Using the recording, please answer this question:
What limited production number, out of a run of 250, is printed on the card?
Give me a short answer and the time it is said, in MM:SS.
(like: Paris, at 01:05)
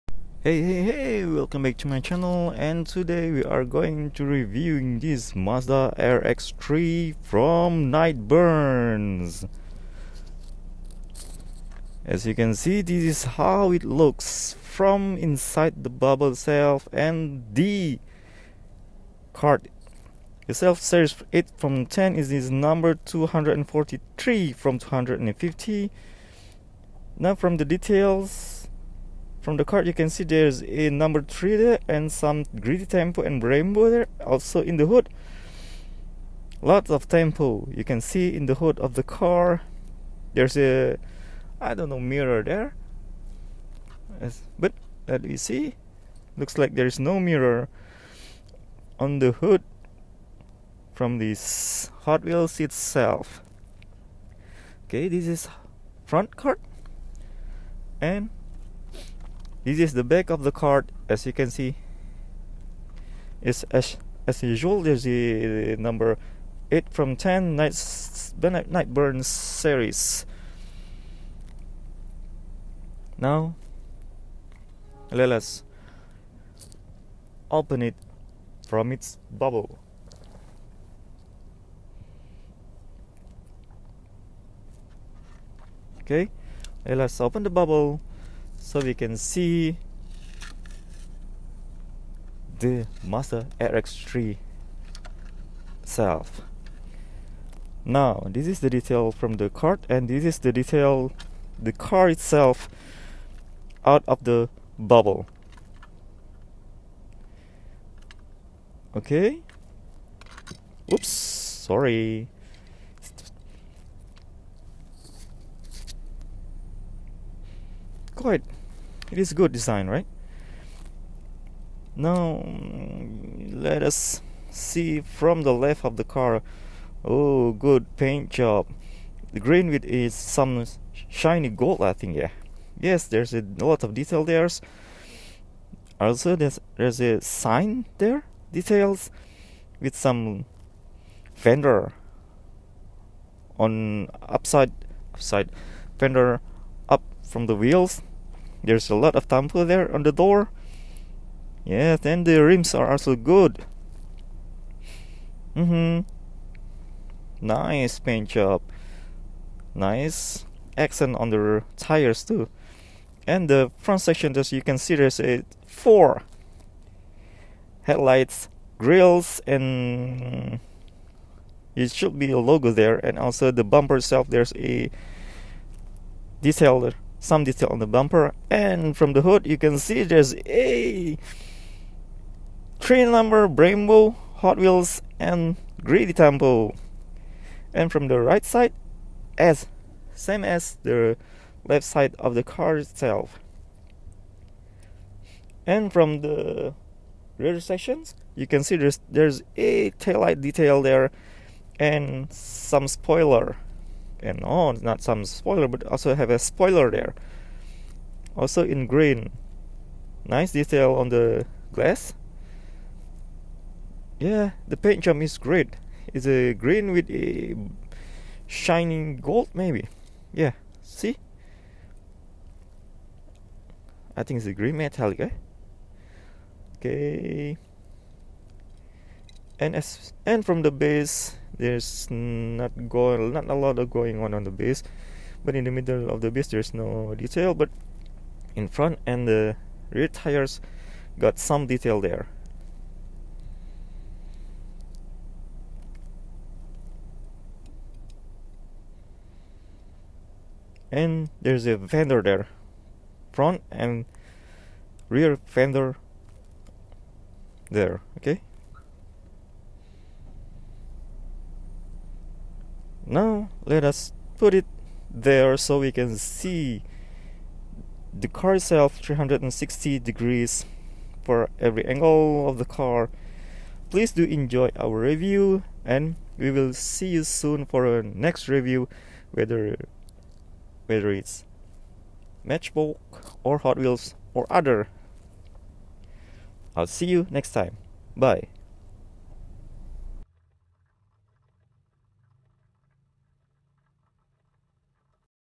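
243, at 00:22.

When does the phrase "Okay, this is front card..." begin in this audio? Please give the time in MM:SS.
00:54.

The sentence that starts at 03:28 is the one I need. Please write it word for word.
Also in green, nice detail on the glass.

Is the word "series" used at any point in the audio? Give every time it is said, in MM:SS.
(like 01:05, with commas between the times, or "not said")
00:20, 01:09.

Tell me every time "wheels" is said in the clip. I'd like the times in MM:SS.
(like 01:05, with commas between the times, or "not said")
00:52, 02:27, 03:04, 04:43.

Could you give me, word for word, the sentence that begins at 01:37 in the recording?
Now, this is the detail from the card and this is the detail the car itself out of the bubble.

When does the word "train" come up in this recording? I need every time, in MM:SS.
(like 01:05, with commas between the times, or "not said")
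03:02.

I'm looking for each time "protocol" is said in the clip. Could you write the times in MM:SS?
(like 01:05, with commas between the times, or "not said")
not said.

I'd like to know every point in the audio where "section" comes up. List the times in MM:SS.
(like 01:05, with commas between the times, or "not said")
02:44, 03:17.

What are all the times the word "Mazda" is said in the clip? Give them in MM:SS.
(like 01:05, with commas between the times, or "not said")
00:05, 01:33.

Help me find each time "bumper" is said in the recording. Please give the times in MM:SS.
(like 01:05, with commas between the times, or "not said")
02:53, 02:57.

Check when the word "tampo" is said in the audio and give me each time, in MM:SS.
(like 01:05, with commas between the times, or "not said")
00:32, 00:37, 02:29, 03:06.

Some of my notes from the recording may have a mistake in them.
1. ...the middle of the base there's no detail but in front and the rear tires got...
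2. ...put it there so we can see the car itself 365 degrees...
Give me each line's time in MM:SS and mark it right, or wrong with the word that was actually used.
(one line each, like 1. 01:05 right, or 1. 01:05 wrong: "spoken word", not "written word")
1. 03:55 right
2. 04:24 wrong: "360", not "365".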